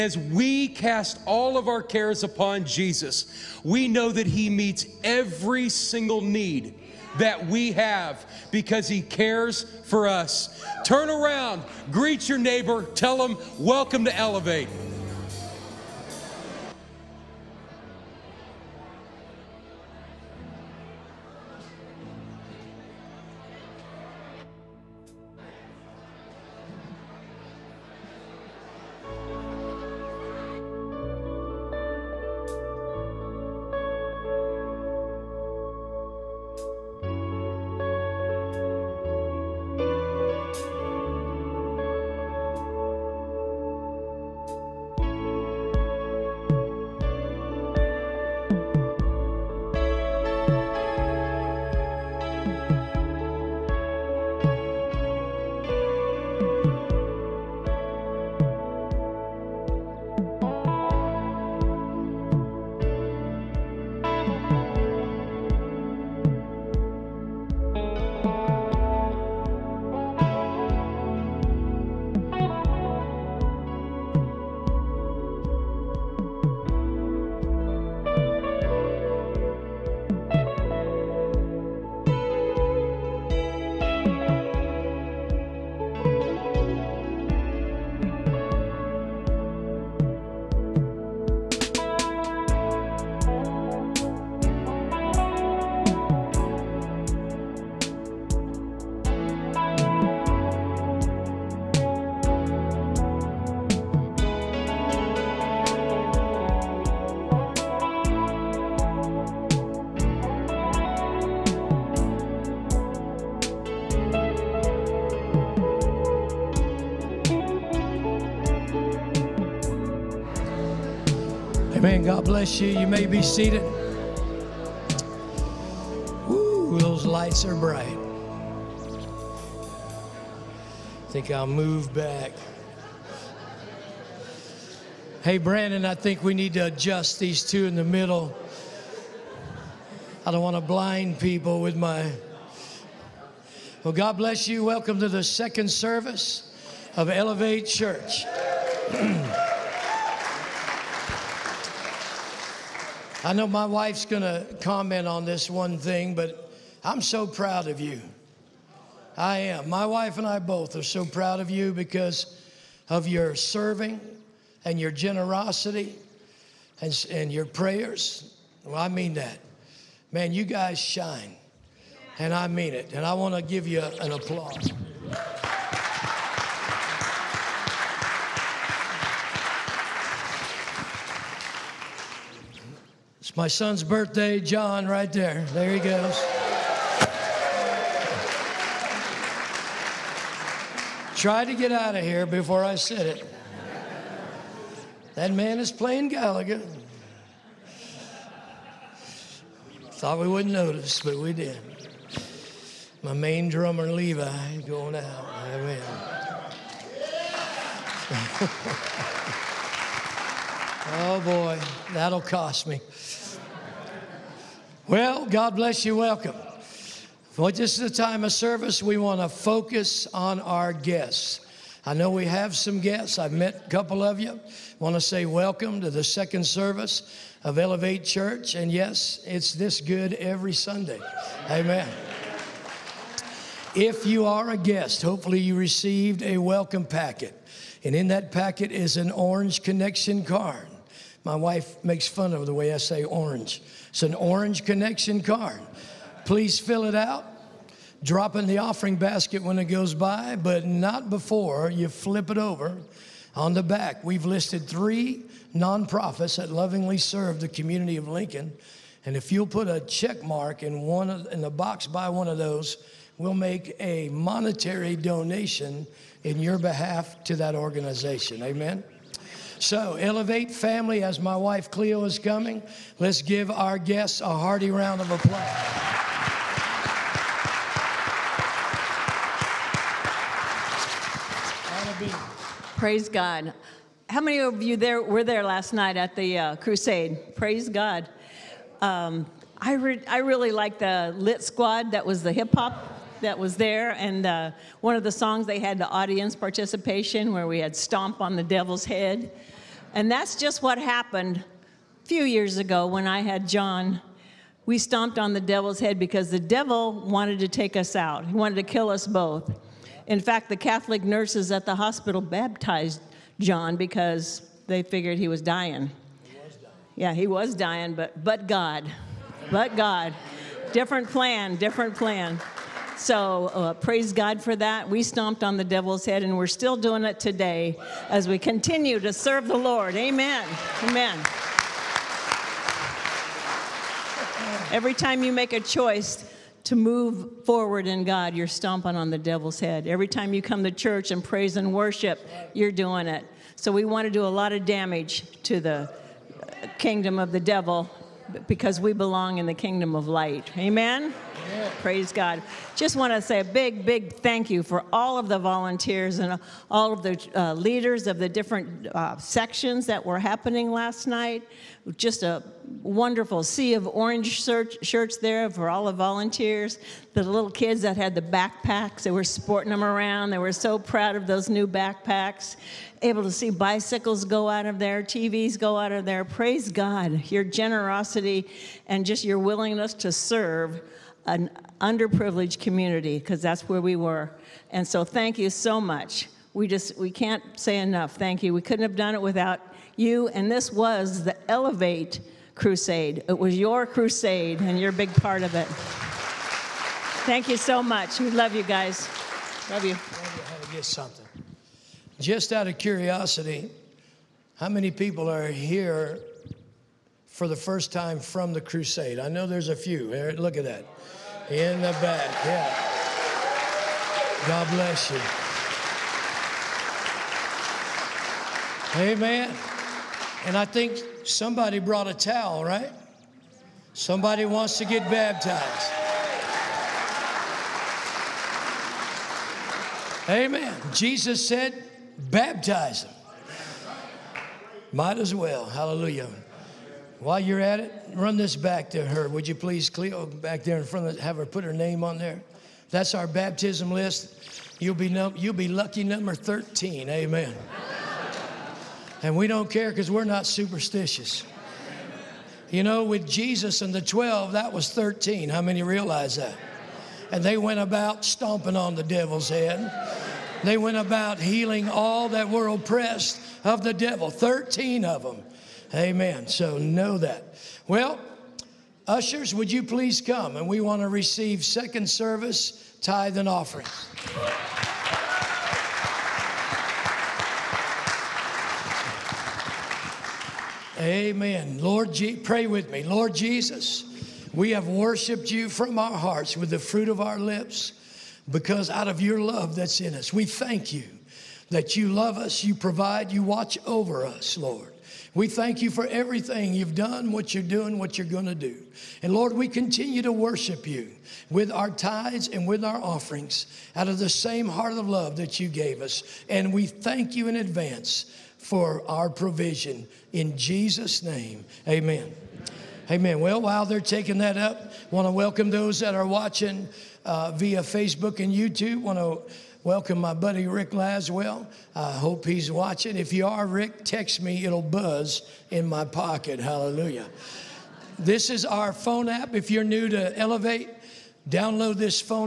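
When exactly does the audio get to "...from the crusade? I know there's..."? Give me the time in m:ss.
6:48.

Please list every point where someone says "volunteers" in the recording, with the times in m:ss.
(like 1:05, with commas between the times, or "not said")
5:55, 6:05.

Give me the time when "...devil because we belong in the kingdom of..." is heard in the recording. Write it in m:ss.
5:47.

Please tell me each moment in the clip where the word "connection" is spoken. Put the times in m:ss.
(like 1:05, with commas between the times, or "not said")
3:59, 4:04.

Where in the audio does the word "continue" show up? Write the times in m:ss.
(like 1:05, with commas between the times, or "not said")
5:28, 8:19.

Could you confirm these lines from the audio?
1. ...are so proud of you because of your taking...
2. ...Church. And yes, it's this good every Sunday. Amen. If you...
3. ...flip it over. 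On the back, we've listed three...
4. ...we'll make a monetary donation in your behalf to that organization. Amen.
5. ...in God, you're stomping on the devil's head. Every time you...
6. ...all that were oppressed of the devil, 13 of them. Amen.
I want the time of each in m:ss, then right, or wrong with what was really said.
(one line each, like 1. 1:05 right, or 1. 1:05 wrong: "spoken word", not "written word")
1. 2:40 wrong: "serving", not "taking"
2. 3:48 right
3. 4:11 right
4. 4:23 right
5. 5:37 right
6. 7:41 right.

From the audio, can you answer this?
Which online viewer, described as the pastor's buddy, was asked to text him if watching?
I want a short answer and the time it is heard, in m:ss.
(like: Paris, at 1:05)
Rick Laswell, at 8:40.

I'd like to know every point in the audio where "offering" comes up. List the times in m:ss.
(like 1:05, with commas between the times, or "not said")
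4:08, 7:53, 8:22.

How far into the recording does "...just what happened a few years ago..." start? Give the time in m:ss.
5:00.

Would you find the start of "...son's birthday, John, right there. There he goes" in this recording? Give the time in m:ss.
3:03.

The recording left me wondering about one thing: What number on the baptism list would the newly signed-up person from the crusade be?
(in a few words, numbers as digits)
13.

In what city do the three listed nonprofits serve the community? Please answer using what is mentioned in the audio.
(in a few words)
Lincoln.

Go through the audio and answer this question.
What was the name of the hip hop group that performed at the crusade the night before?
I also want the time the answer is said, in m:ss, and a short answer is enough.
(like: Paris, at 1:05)
Lit Squad, at 4:51.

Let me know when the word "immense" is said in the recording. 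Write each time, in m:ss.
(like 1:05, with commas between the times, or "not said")
not said.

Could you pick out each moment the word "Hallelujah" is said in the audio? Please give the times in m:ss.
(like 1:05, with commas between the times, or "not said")
7:15, 8:46.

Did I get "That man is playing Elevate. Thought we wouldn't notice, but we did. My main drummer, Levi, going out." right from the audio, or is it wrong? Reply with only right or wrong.
wrong.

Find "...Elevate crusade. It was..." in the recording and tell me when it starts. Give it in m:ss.
6:31.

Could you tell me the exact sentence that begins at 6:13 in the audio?
Able to see bicycles go out of there, TVs go out of there.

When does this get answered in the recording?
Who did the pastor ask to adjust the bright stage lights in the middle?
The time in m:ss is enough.
2:15.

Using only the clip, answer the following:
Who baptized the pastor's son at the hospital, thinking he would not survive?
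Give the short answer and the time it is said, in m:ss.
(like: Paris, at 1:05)
Catholic nurses, at 5:10.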